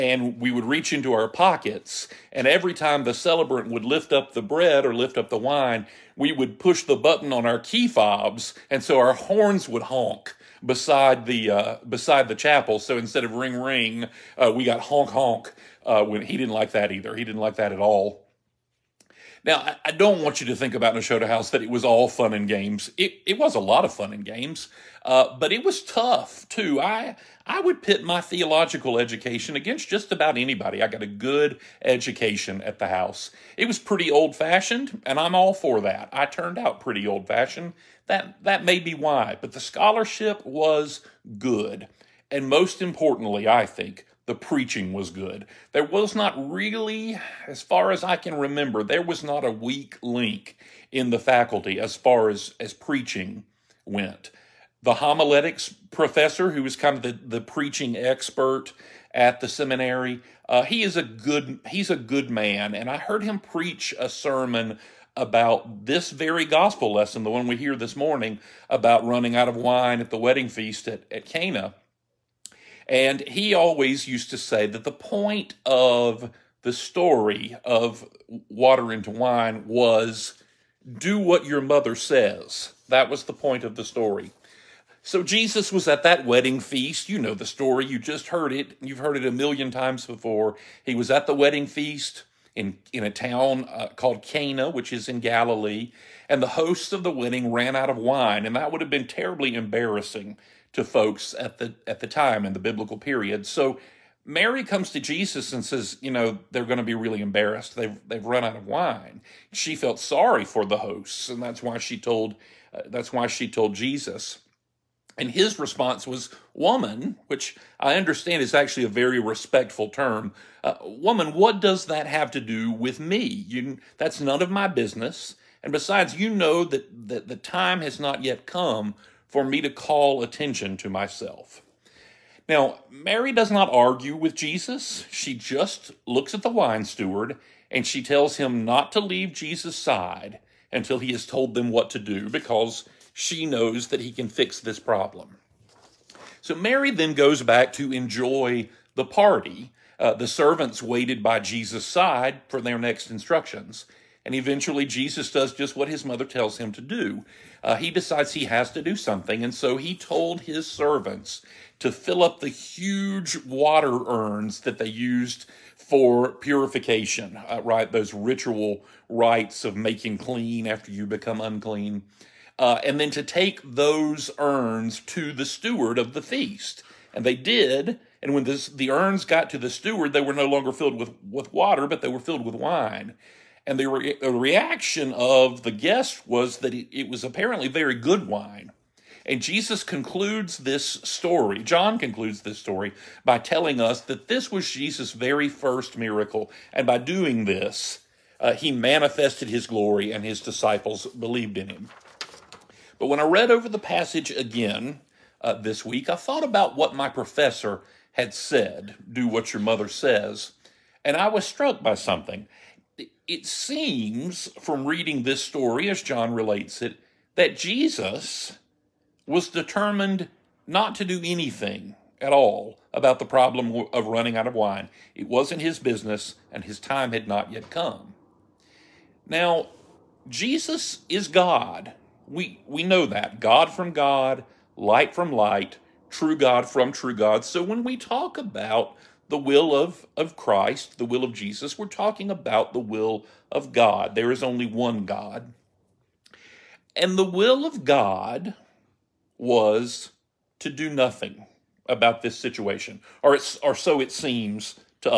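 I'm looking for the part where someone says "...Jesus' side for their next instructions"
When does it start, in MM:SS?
02:31.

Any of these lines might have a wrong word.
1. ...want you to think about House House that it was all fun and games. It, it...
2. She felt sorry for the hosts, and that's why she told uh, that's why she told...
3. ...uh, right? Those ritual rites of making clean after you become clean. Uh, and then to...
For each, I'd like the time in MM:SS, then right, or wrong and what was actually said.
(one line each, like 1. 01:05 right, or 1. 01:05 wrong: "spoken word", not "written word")
1. 00:20 wrong: "Nashotah", not "House"
2. 01:49 right
3. 02:47 wrong: "unclean", not "clean".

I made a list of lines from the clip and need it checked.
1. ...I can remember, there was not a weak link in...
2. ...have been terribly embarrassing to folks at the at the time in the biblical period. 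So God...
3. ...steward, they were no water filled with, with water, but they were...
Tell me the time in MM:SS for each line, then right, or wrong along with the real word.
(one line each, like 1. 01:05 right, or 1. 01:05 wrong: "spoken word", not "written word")
1. 00:48 right
2. 01:38 wrong: "Mary", not "God"
3. 02:59 wrong: "longer", not "water".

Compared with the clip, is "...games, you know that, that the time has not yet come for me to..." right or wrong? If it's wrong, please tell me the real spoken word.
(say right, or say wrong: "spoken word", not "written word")
wrong: "besides", not "games".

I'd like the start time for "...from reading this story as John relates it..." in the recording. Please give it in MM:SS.
03:34.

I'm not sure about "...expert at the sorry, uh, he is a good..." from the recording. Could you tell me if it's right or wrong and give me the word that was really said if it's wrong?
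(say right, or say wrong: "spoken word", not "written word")
wrong: "seminary", not "sorry".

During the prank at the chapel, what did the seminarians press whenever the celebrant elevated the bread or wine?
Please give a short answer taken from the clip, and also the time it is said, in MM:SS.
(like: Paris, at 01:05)
key fobs, at 00:07.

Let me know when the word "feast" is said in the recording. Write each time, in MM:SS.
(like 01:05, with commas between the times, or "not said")
01:10, 01:26, 01:31, 02:56.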